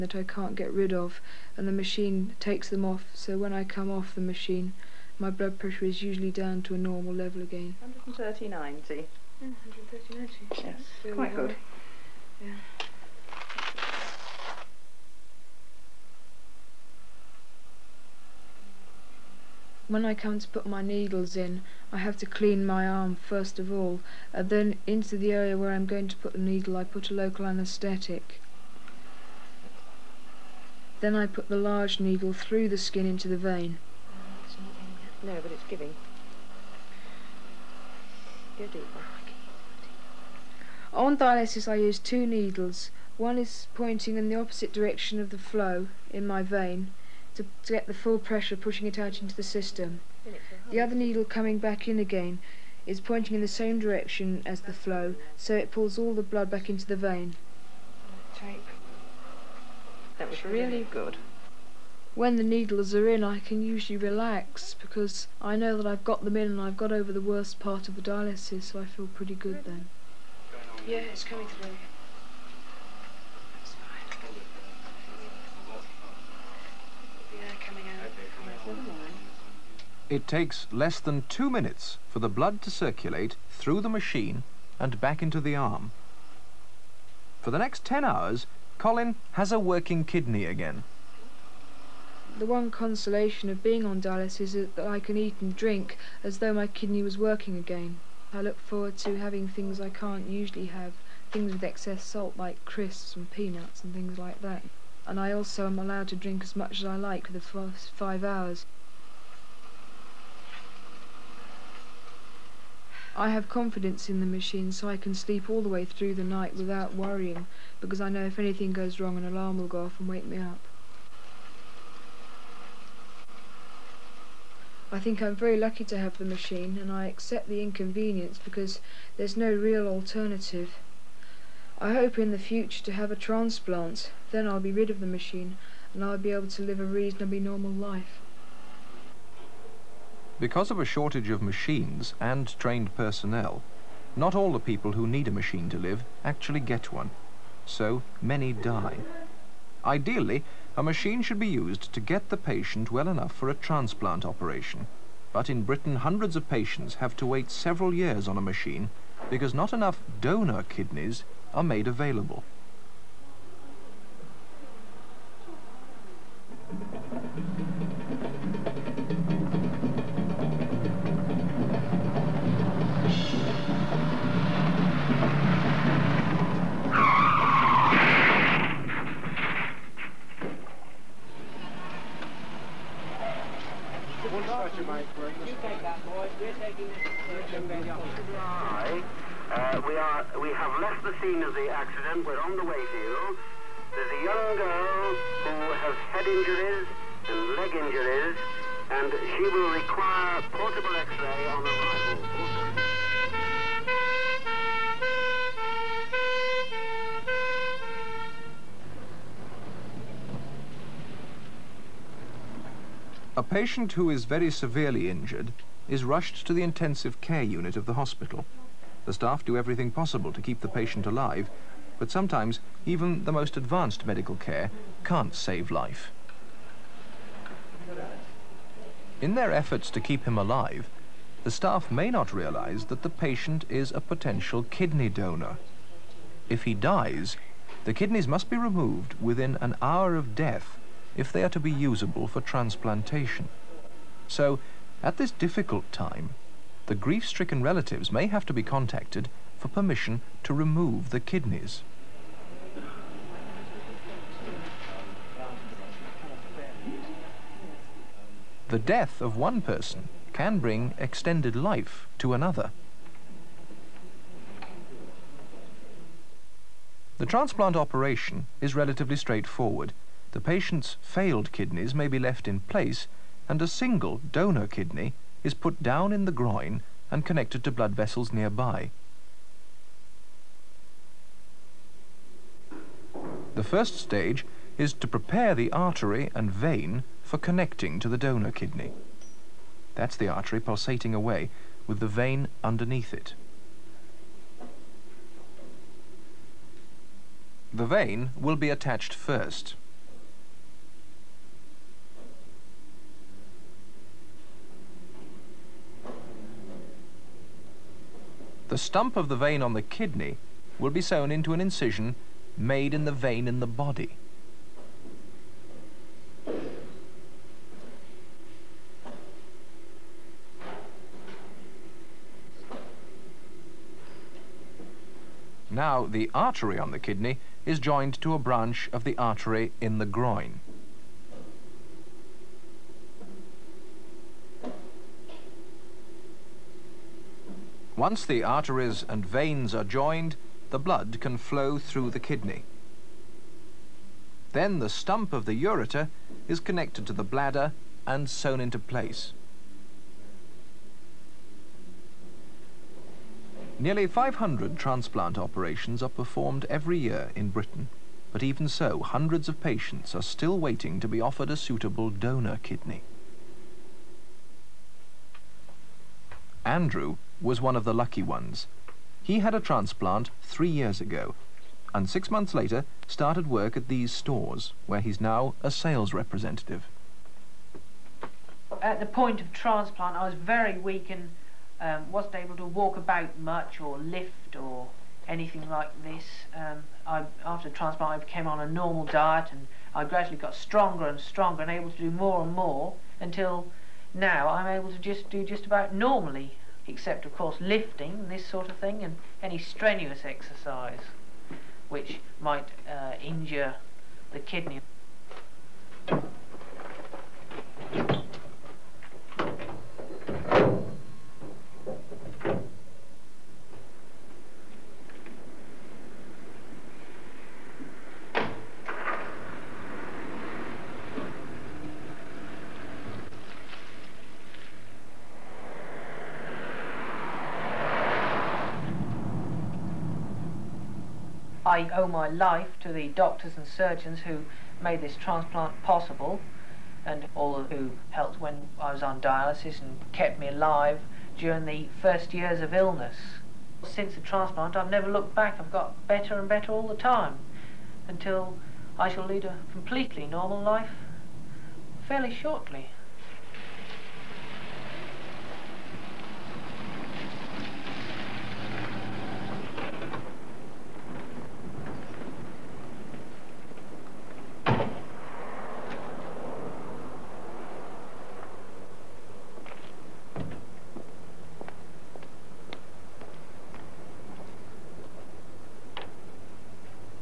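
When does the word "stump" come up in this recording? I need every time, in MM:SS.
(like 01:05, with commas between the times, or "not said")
05:08, 05:44.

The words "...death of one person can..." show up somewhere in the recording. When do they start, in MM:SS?
04:18.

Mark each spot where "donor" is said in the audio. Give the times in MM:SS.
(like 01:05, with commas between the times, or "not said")
02:40, 03:55, 04:34, 04:48, 06:02.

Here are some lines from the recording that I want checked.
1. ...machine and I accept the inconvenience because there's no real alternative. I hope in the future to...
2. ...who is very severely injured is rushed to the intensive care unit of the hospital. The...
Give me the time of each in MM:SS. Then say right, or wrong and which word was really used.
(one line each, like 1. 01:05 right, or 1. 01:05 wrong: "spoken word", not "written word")
1. 02:06 right
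2. 03:33 right.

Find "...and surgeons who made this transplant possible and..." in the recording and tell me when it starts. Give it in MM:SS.
07:13.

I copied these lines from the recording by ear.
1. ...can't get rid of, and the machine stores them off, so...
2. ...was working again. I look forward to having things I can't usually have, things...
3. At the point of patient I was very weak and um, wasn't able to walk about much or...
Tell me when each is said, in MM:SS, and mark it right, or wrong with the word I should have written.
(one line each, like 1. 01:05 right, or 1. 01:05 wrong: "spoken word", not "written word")
1. 00:00 wrong: "takes", not "stores"
2. 01:37 right
3. 06:18 wrong: "transplant", not "patient".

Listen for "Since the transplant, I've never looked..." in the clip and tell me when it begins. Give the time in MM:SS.
07:23.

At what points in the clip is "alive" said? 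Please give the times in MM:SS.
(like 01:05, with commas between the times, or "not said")
03:41, 03:50, 07:20.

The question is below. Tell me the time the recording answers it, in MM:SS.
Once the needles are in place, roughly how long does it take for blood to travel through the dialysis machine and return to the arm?
01:20.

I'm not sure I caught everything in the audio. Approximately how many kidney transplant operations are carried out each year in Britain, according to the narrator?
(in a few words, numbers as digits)
nearly 500.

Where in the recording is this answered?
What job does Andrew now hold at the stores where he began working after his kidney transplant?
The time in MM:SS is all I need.
06:15.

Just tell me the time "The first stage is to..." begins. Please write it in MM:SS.
04:43.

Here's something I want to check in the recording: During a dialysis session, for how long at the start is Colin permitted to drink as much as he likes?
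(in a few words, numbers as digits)
first 5 hours.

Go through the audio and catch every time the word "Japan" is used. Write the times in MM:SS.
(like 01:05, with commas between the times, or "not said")
not said.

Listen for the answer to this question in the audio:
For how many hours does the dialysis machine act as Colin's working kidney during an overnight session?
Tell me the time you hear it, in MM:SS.
01:27.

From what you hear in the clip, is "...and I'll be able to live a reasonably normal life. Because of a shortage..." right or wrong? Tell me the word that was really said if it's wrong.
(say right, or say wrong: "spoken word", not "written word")
right.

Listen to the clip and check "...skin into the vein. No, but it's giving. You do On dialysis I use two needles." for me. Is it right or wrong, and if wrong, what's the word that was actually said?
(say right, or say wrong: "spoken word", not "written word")
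right.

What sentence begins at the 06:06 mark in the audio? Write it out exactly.
Andrew was one of the lucky ones.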